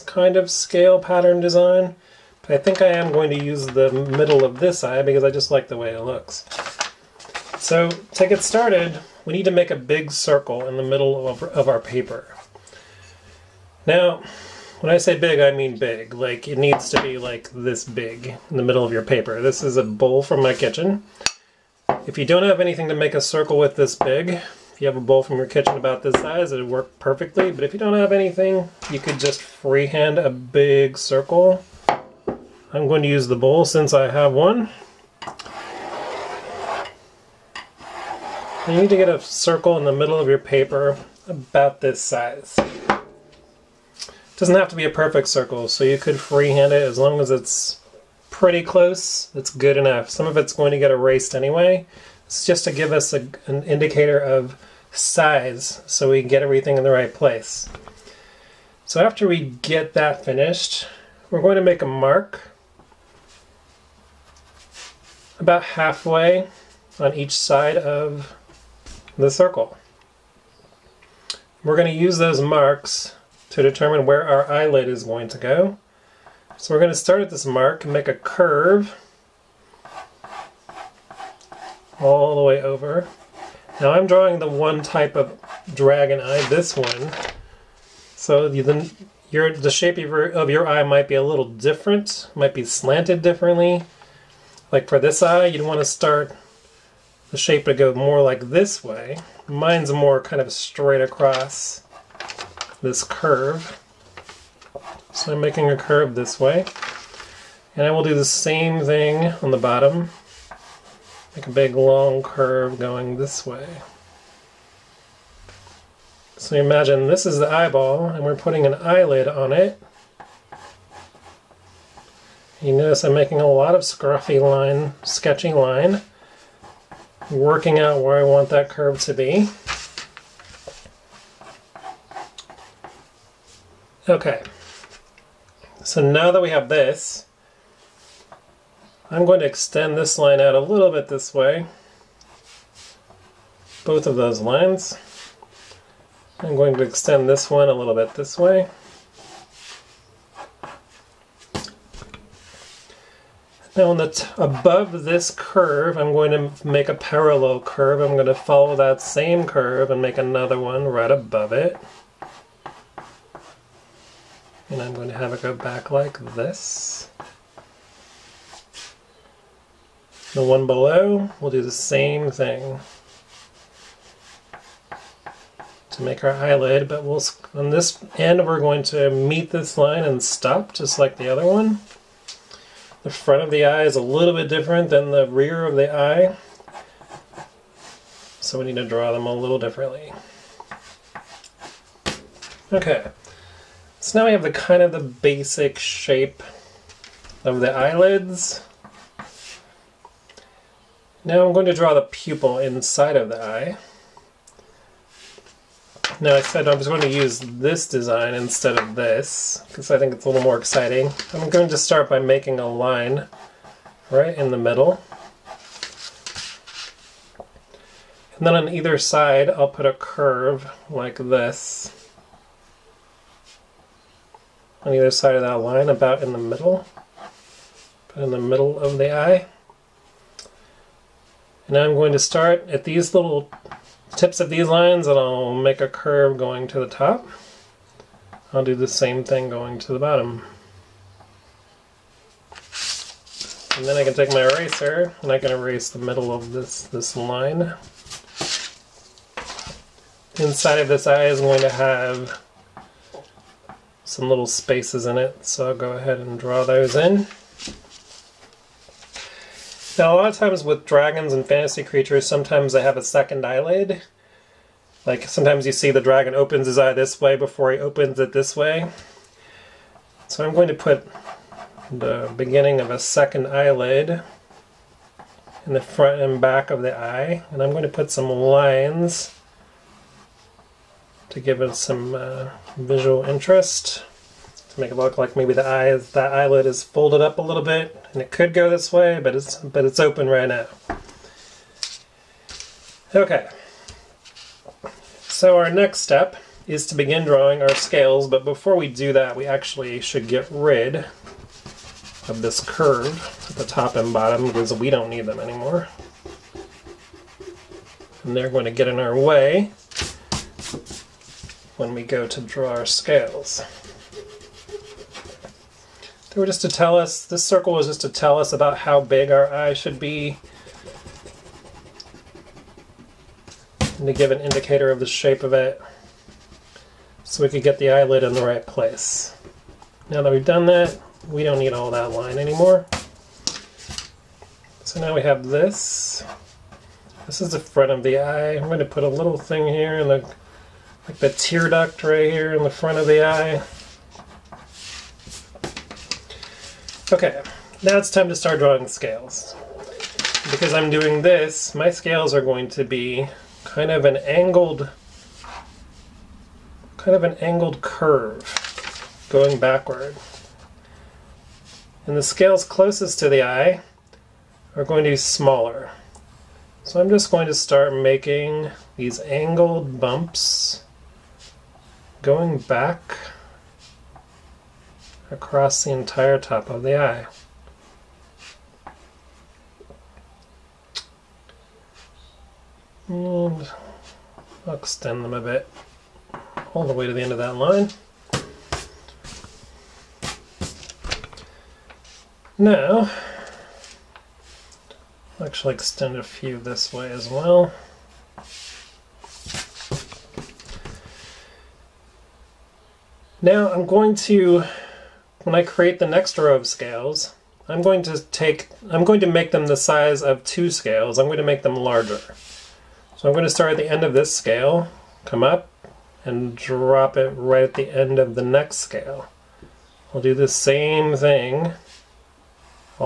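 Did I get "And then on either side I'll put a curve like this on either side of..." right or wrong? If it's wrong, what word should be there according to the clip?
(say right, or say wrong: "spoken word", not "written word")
right.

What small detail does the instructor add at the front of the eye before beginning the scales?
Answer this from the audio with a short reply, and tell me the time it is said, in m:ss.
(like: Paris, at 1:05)
The tear duct, at 5:41.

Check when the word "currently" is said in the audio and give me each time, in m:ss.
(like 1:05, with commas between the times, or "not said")
not said.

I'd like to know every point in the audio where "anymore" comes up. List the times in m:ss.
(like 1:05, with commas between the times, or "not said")
5:05, 5:32.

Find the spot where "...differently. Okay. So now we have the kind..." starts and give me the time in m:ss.
3:09.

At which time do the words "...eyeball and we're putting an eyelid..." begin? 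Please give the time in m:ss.
1:57.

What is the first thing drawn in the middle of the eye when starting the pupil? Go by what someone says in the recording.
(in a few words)
A line.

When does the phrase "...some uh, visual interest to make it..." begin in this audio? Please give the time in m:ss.
4:41.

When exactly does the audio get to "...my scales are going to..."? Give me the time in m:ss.
5:51.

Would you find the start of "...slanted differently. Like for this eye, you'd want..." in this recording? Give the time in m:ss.
1:32.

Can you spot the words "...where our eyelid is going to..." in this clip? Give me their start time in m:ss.
1:14.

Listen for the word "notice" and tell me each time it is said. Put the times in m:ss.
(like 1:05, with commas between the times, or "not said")
2:02.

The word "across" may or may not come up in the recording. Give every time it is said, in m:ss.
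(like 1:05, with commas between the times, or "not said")
1:41, 6:15.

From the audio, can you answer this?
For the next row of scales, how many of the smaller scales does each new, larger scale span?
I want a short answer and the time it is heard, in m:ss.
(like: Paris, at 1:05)
2, at 6:50.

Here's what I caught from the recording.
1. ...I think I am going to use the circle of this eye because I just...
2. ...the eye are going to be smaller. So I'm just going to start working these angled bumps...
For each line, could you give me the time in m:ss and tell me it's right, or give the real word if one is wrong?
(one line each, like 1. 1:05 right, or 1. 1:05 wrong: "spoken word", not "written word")
1. 0:02 wrong: "middle", not "circle"
2. 6:03 wrong: "making", not "working".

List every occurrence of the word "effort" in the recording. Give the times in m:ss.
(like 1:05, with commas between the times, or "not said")
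not said.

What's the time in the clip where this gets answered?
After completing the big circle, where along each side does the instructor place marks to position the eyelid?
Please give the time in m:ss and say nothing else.
1:05.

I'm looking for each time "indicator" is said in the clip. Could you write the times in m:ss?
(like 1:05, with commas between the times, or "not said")
0:53, 5:24.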